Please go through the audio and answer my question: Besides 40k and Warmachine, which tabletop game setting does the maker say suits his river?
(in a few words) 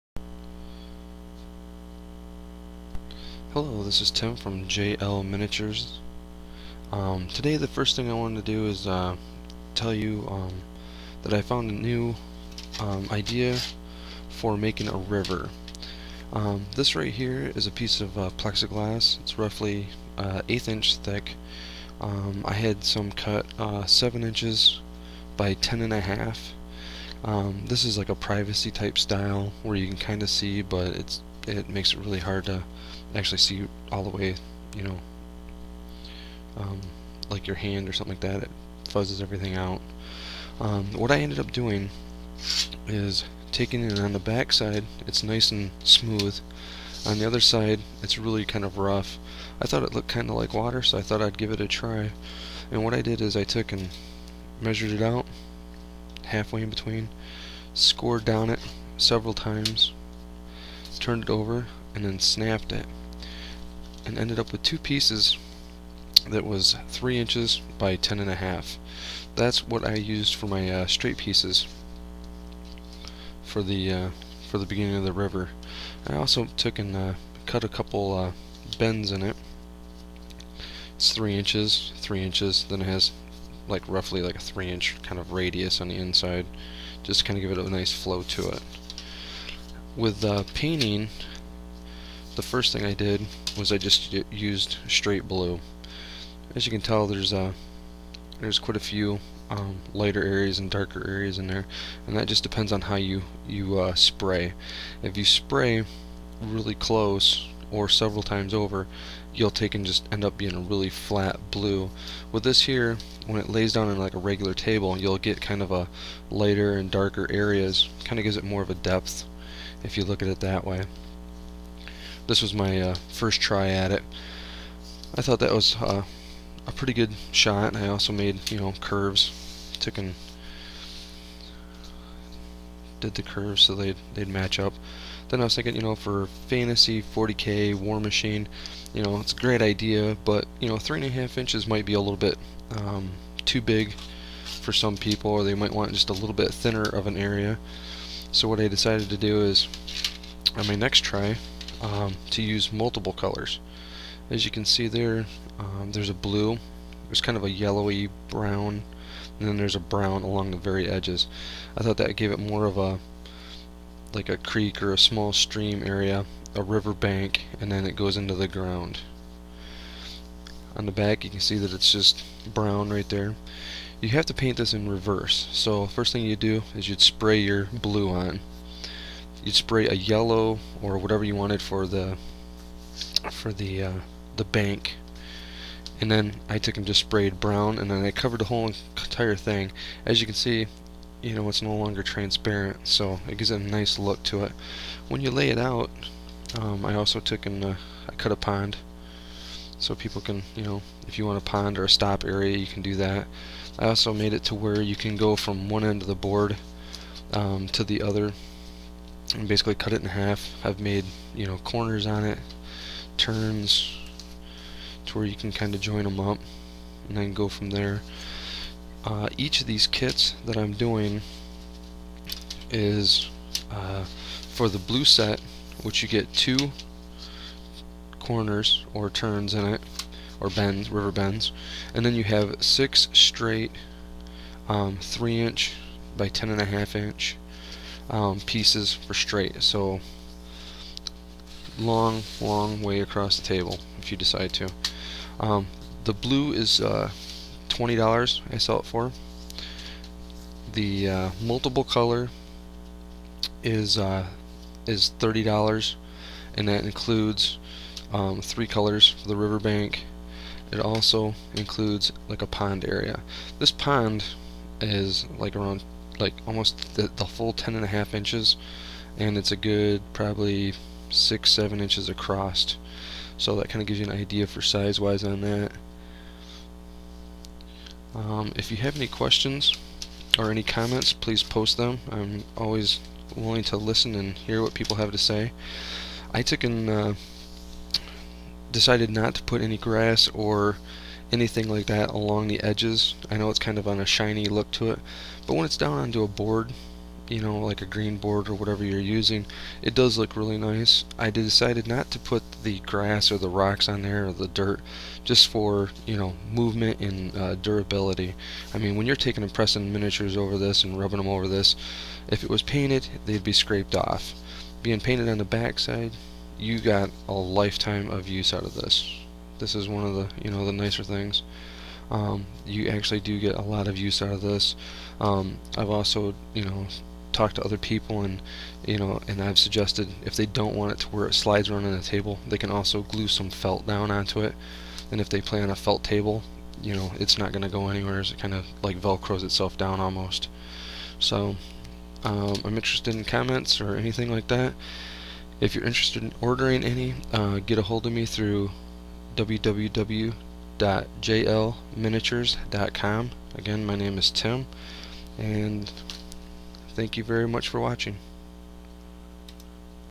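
Fantasy.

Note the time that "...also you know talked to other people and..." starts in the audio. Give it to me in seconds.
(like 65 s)
325 s.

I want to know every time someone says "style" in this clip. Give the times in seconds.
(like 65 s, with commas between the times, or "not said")
28 s.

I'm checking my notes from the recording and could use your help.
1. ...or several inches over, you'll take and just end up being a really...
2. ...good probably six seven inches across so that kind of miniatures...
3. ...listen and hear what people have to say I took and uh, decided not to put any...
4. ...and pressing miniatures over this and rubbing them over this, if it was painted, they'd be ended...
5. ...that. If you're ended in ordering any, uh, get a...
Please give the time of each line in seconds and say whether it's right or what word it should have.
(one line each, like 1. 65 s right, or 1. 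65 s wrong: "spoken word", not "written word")
1. 107 s wrong: "times", not "inches"
2. 269 s wrong: "gives", not "miniatures"
3. 283 s right
4. 309 s wrong: "scraped", not "ended"
5. 344 s wrong: "interested", not "ended".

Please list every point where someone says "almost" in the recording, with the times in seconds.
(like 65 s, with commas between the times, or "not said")
266 s, 340 s.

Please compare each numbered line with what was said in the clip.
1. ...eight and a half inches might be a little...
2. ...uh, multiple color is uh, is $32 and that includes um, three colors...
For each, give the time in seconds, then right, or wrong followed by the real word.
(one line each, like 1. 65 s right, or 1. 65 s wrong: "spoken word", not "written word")
1. 140 s wrong: "three", not "eight"
2. 251 s wrong: "30", not "32".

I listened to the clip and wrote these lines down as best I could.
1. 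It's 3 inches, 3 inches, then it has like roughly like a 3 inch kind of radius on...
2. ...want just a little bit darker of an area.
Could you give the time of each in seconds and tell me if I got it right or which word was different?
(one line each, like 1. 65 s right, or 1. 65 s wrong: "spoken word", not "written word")
1. 80 s right
2. 145 s wrong: "thinner", not "darker".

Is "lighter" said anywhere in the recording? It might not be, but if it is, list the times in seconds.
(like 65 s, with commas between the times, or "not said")
99 s, 116 s.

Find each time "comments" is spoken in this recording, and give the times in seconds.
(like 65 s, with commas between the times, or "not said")
280 s, 343 s.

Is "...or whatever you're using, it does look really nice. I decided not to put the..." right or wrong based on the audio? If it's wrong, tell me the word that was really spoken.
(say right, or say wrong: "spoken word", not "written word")
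right.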